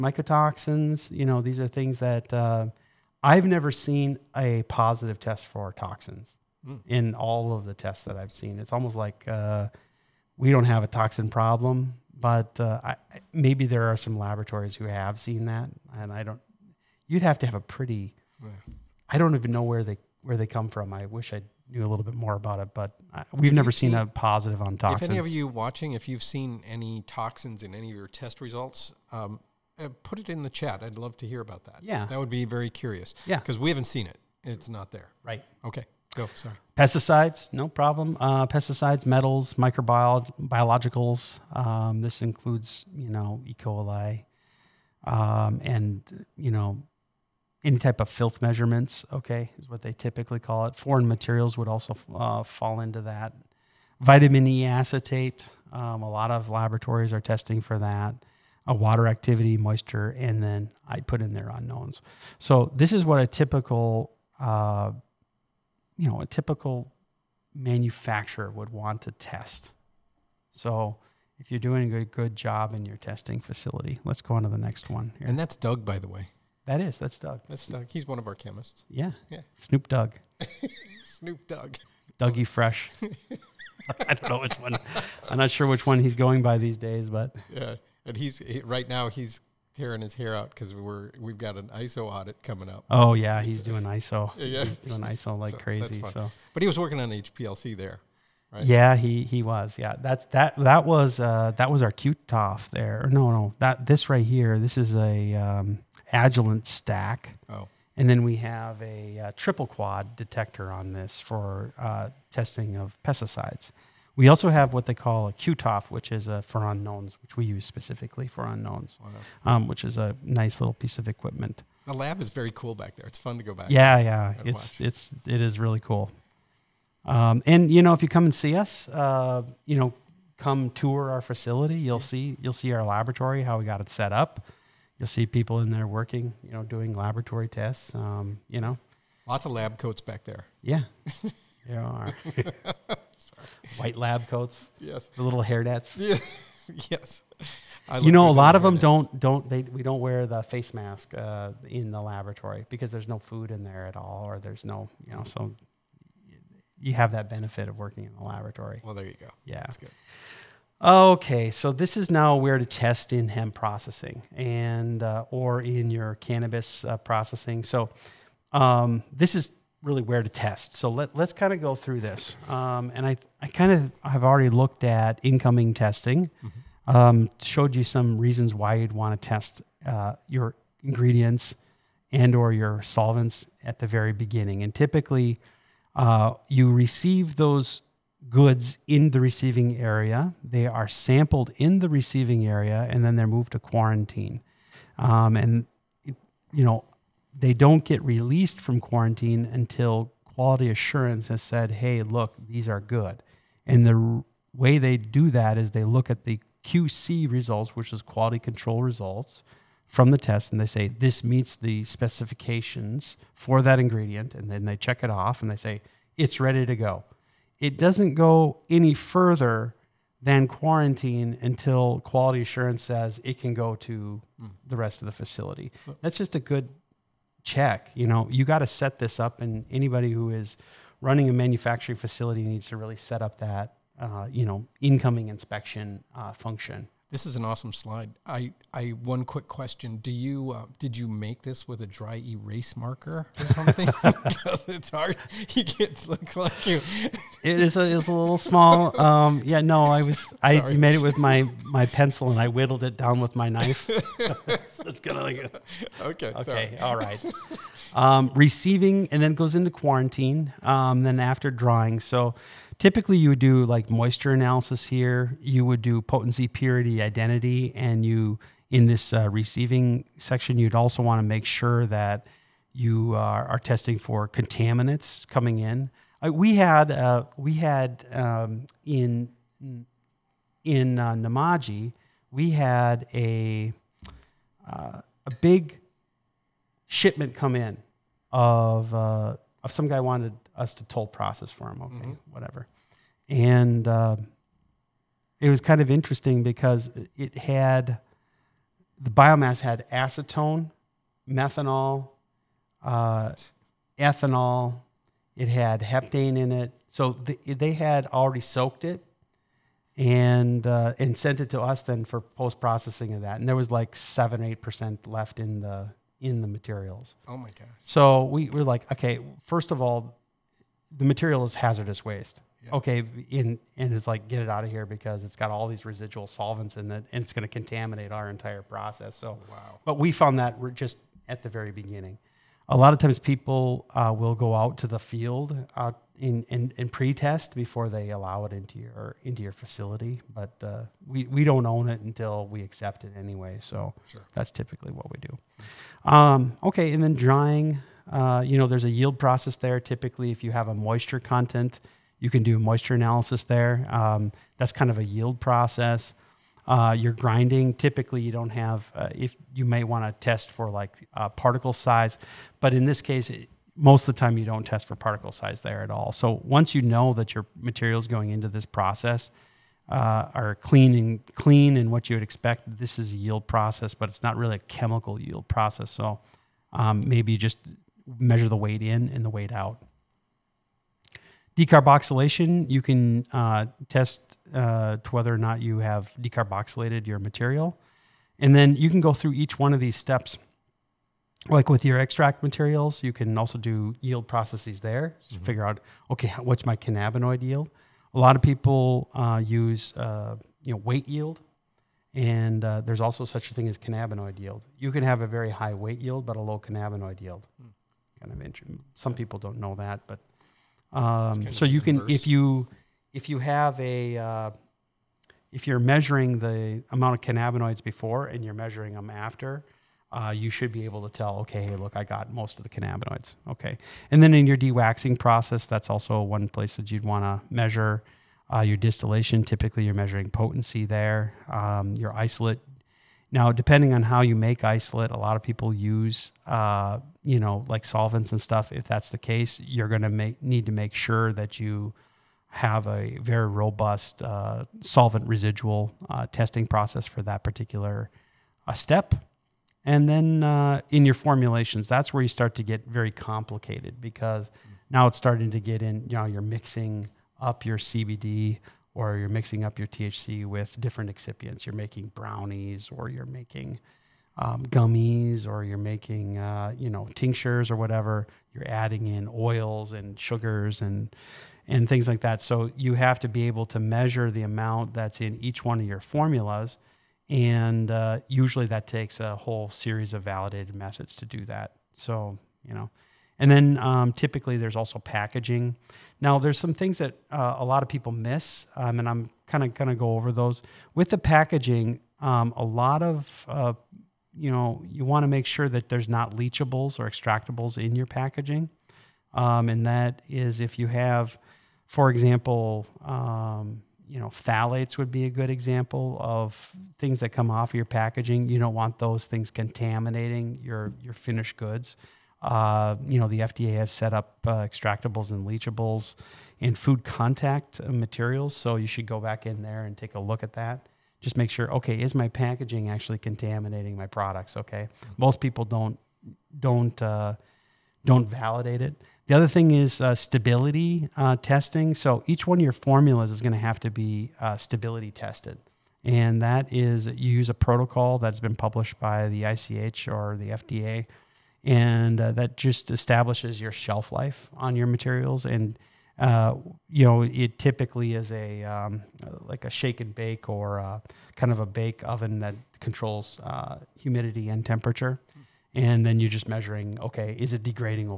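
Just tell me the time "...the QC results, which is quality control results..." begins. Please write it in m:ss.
3:26.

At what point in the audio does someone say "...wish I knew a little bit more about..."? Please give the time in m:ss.
0:21.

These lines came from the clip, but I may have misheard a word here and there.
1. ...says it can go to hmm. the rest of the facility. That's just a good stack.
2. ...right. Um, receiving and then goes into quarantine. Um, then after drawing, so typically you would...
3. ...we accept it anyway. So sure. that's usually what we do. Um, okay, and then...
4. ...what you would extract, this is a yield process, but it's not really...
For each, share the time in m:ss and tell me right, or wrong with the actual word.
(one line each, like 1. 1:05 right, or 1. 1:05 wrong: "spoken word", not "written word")
1. 3:42 wrong: "check", not "stack"
2. 4:16 right
3. 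5:42 wrong: "typically", not "usually"
4. 6:11 wrong: "expect", not "extract".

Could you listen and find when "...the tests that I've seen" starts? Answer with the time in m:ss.
0:07.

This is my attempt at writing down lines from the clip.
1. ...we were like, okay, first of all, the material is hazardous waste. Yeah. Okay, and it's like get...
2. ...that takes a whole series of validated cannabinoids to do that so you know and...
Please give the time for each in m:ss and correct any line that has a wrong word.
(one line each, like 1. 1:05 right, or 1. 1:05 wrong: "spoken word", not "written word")
1. 5:18 right
2. 7:58 wrong: "methods", not "cannabinoids".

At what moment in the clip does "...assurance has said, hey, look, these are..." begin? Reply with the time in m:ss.
3:20.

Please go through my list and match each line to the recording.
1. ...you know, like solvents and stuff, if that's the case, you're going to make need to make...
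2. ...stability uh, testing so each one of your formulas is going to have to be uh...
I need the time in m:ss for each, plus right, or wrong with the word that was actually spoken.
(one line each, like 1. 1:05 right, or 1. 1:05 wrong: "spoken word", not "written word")
1. 7:17 right
2. 8:50 right.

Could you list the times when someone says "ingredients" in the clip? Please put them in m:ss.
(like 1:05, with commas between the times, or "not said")
3:00, 3:33.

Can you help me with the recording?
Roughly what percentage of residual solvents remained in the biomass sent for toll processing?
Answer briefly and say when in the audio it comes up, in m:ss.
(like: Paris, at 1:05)
7-8 percent, at 5:13.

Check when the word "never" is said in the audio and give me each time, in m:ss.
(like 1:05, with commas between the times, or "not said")
0:03, 0:23.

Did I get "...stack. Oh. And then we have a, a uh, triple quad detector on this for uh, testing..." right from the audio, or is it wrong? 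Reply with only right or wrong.
right.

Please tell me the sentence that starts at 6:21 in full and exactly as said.
Decarboxylation, you can uh, test uh, to whether or not you have decarboxylated your material.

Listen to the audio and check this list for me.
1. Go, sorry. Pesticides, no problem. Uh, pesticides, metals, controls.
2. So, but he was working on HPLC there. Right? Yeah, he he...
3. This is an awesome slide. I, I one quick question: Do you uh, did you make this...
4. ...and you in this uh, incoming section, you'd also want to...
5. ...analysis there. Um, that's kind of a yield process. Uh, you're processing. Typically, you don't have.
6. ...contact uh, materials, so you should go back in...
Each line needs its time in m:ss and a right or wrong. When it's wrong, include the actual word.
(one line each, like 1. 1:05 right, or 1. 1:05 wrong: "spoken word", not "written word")
1. 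0:36 wrong: "microbiologicals", not "controls"
2. 1:36 right
3. 3:57 right
4. 4:27 wrong: "receiving", not "incoming"
5. 5:52 wrong: "grinding", not "processing"
6. 8:37 right.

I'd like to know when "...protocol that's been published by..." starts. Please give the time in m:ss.
8:57.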